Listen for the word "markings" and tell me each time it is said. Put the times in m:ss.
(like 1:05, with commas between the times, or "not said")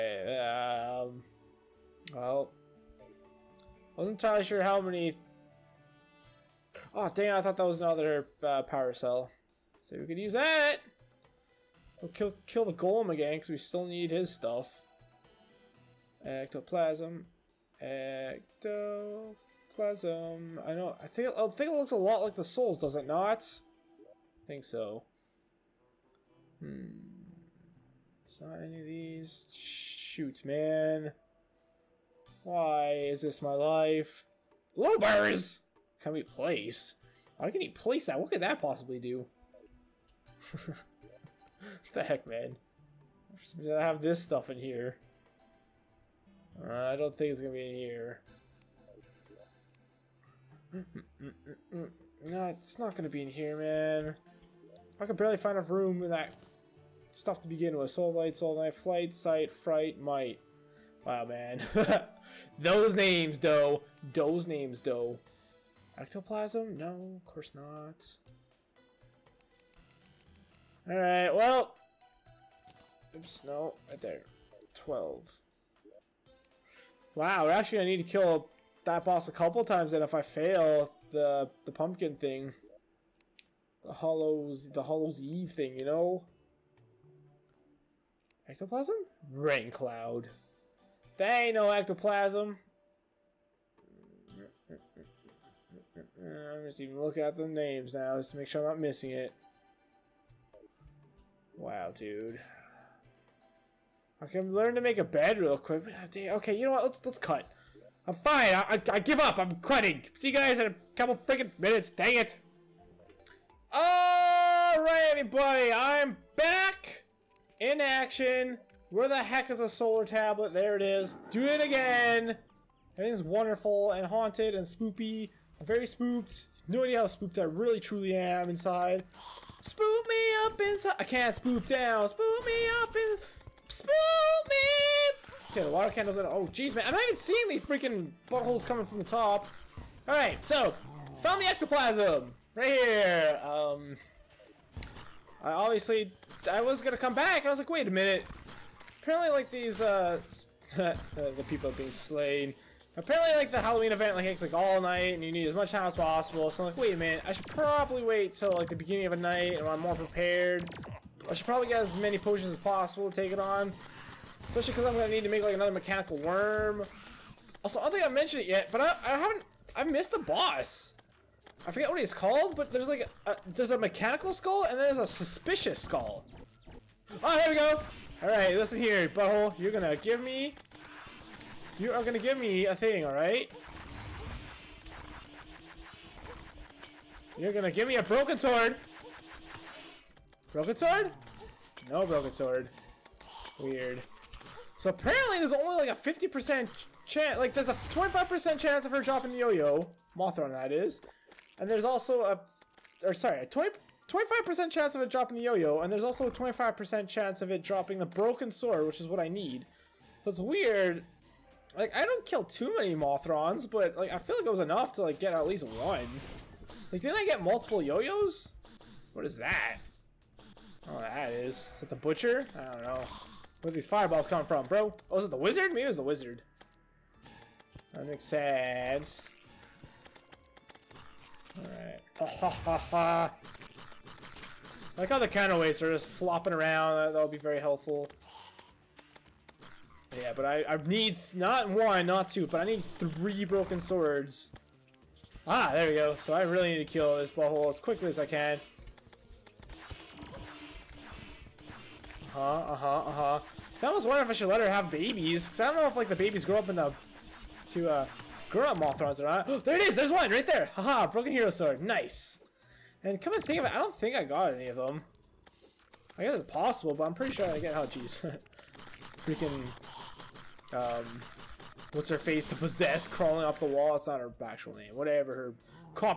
not said.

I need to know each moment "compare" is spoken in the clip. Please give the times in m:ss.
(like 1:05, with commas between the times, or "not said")
not said.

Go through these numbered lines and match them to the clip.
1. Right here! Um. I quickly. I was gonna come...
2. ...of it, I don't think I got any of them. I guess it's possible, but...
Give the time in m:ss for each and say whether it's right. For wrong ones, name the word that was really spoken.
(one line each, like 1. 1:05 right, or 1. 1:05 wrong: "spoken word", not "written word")
1. 2:22 wrong: "obviously", not "quickly"
2. 4:23 right.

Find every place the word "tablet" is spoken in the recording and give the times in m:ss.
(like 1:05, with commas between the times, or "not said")
2:00.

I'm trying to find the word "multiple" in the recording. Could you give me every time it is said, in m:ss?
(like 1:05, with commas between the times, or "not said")
3:37.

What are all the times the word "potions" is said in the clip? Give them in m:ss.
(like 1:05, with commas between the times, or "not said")
2:42.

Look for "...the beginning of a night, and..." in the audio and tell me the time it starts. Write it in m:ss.
2:38.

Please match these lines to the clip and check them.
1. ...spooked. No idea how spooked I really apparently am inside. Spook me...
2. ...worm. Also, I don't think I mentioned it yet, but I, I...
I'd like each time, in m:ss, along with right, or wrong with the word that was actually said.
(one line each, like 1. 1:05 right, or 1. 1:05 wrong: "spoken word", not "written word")
1. 2:05 wrong: "truly", not "apparently"
2. 2:46 right.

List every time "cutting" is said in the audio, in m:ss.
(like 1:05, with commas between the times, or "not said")
1:49.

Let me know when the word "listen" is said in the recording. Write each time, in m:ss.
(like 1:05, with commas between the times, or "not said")
2:58.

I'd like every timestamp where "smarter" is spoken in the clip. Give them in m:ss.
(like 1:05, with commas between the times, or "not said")
not said.